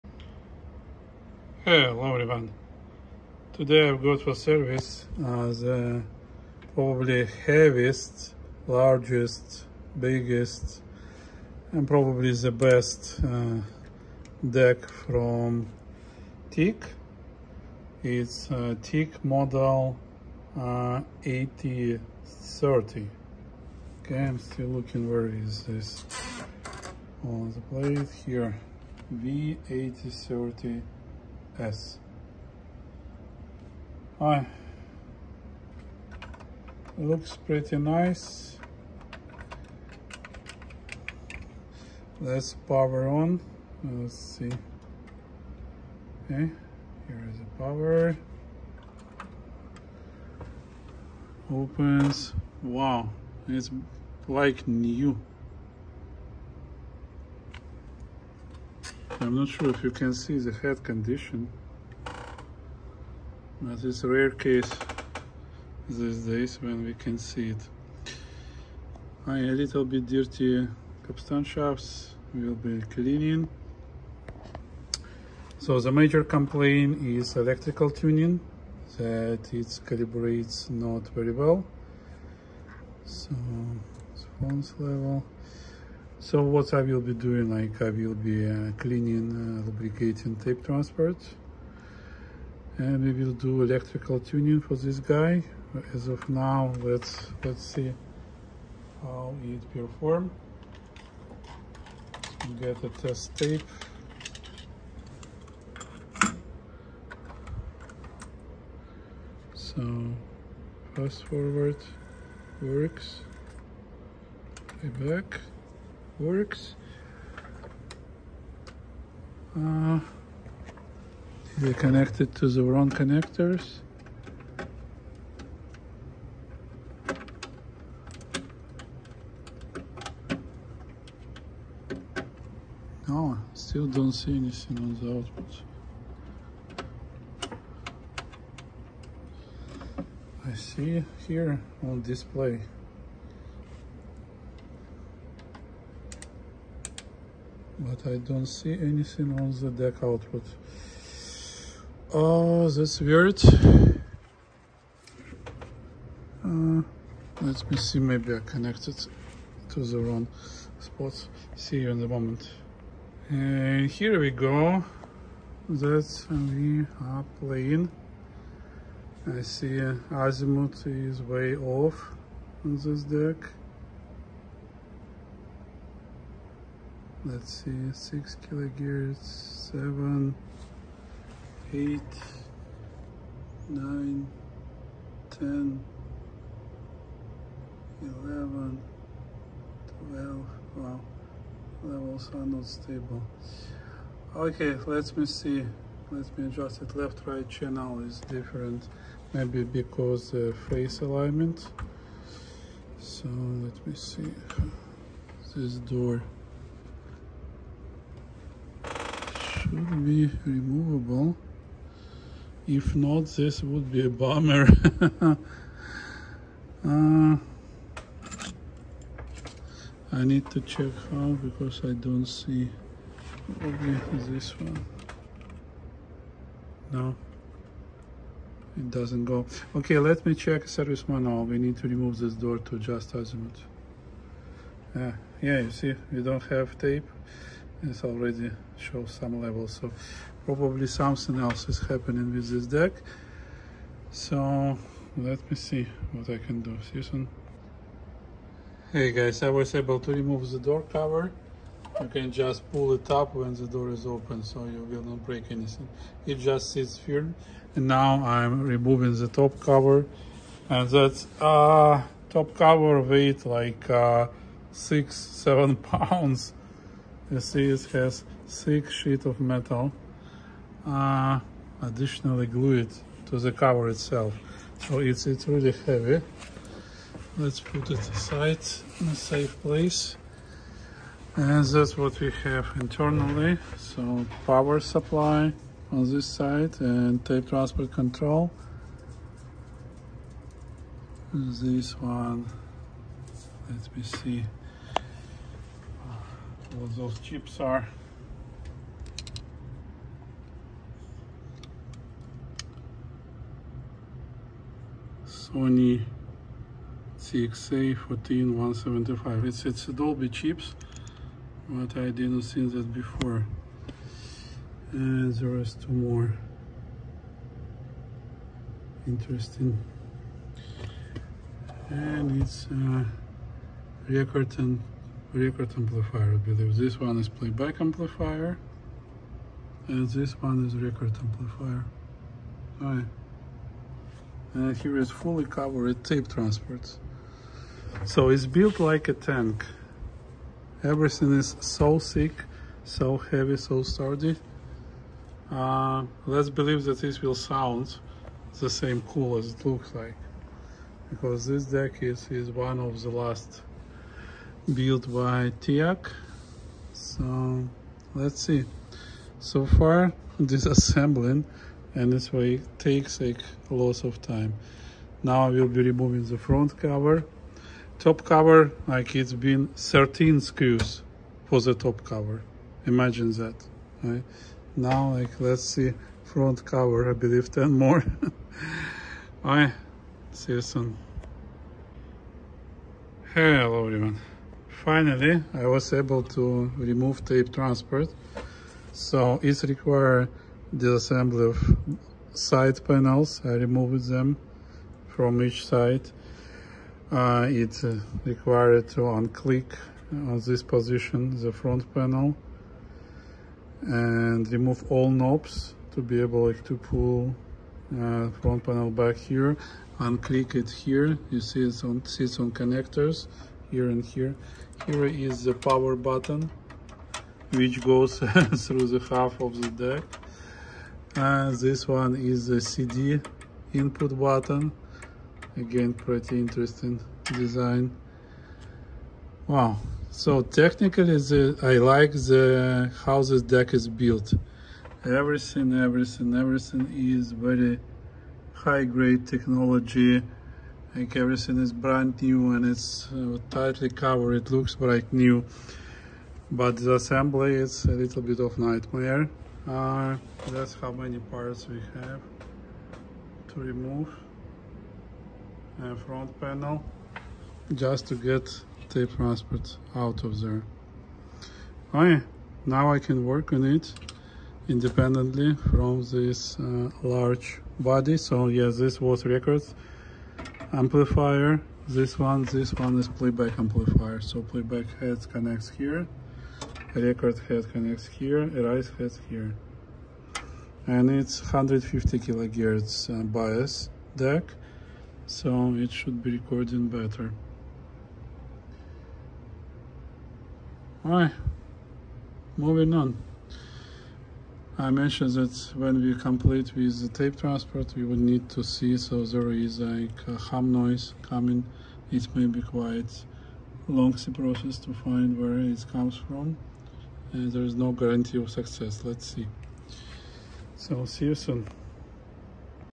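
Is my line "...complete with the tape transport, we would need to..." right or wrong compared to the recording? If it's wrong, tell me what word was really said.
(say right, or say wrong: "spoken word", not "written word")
right.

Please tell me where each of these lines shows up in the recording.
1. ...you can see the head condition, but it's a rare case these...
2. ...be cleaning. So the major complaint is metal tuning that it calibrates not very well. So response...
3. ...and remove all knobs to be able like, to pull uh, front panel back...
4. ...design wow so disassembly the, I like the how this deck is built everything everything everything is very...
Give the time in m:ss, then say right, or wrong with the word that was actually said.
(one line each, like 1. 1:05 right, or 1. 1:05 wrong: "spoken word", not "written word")
1. 0:59 right
2. 1:12 wrong: "electrical", not "metal"
3. 6:43 right
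4. 7:07 wrong: "technically", not "disassembly".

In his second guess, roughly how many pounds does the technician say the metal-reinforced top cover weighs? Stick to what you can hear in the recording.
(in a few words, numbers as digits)
7.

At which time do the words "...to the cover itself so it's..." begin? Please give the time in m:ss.
4:33.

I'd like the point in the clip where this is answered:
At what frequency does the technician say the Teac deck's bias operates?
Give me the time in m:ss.
8:01.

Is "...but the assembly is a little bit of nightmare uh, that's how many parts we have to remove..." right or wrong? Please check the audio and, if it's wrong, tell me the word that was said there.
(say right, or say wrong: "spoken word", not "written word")
right.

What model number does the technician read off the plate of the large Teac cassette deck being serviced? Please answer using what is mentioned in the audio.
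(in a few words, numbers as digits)
V8030.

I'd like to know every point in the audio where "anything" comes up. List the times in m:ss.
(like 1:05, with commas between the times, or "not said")
2:14, 2:28, 4:15.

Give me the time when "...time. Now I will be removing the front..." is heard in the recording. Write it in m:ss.
6:04.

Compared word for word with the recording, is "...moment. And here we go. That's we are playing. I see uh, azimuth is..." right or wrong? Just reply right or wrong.
right.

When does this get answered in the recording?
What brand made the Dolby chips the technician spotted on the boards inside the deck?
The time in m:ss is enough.
5:05.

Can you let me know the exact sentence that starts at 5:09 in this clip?
It's it's Dolby chips, but I didn't see that before.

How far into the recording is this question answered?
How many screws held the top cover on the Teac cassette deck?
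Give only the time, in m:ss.
6:09.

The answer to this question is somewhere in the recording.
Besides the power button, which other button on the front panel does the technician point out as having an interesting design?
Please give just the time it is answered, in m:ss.
7:02.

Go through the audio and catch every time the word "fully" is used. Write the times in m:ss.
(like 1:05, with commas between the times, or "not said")
5:35.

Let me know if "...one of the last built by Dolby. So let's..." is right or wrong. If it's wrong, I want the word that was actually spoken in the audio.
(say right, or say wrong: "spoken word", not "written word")
wrong: "Teac", not "Dolby".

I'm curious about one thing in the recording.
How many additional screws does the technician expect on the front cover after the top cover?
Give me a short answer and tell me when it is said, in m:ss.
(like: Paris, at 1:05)
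10, at 6:17.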